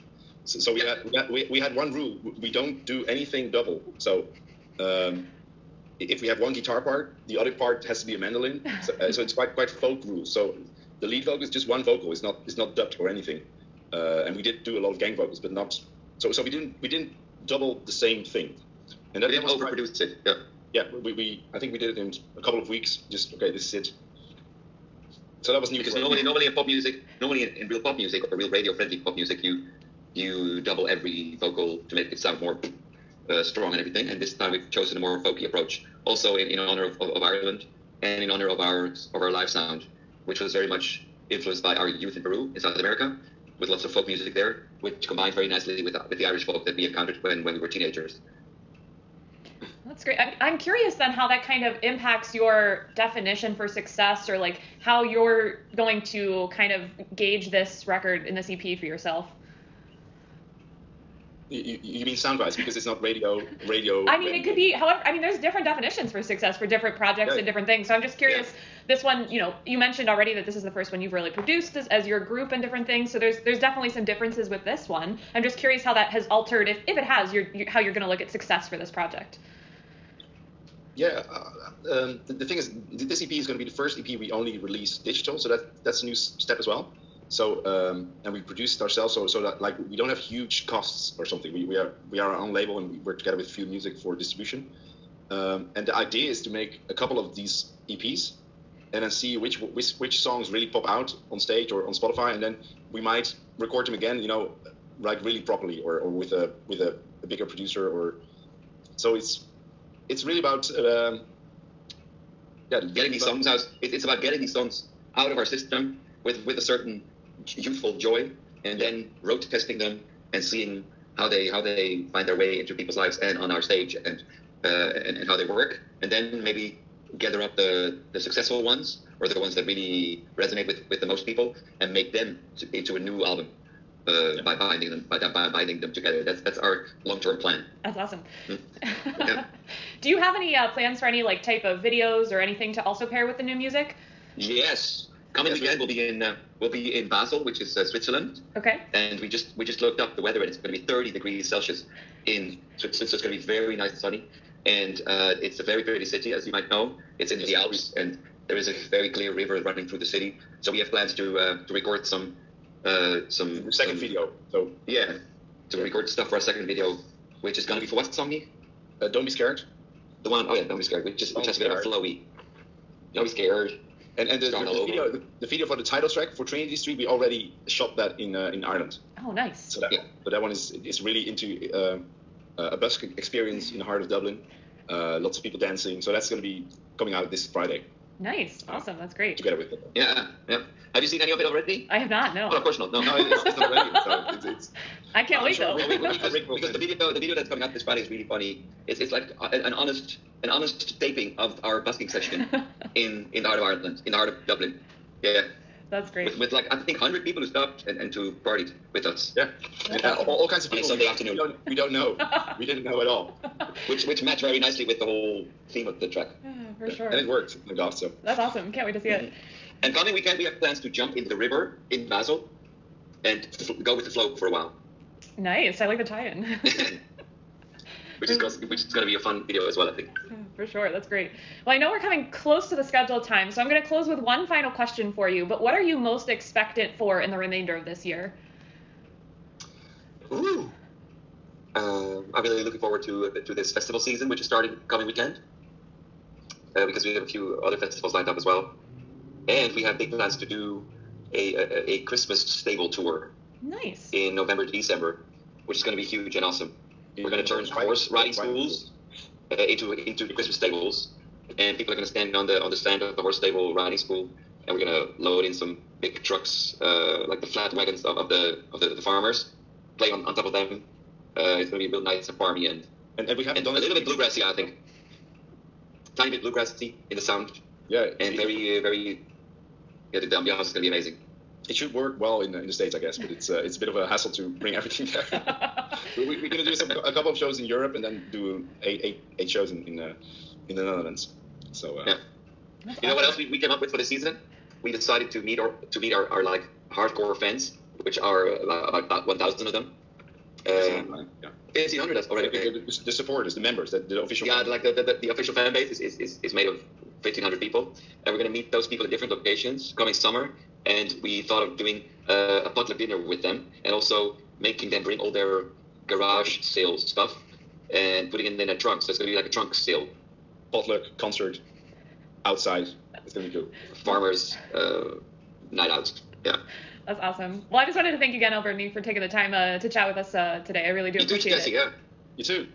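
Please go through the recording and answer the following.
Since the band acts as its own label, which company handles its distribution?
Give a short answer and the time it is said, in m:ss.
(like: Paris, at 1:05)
Few Music, at 1:33.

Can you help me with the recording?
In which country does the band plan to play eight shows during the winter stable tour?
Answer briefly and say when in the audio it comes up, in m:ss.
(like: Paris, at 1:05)
The Netherlands, at 4:50.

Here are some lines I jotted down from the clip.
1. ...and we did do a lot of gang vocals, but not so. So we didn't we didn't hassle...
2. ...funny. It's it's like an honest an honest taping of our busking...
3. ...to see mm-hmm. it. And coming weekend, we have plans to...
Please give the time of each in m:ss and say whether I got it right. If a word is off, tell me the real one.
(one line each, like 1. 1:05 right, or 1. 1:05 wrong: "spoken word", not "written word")
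1. 0:14 wrong: "double", not "hassle"
2. 3:18 right
3. 3:38 right.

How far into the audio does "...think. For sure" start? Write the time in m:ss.
3:49.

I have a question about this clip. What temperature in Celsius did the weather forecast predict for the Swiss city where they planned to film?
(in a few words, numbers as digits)
30 degrees.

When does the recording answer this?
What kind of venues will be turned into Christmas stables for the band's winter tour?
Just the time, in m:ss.
4:17.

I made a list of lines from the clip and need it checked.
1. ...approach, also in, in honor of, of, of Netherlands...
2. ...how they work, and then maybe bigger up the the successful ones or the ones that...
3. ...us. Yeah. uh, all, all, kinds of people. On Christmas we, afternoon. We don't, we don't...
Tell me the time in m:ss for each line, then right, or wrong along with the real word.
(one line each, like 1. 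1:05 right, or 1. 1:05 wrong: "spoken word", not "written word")
1. 0:35 wrong: "Ireland", not "Netherlands"
2. 2:05 wrong: "gather", not "bigger"
3. 3:29 wrong: "Sunday", not "Christmas".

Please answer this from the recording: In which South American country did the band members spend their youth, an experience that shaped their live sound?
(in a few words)
Peru.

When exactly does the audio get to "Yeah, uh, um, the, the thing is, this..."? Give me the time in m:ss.
1:20.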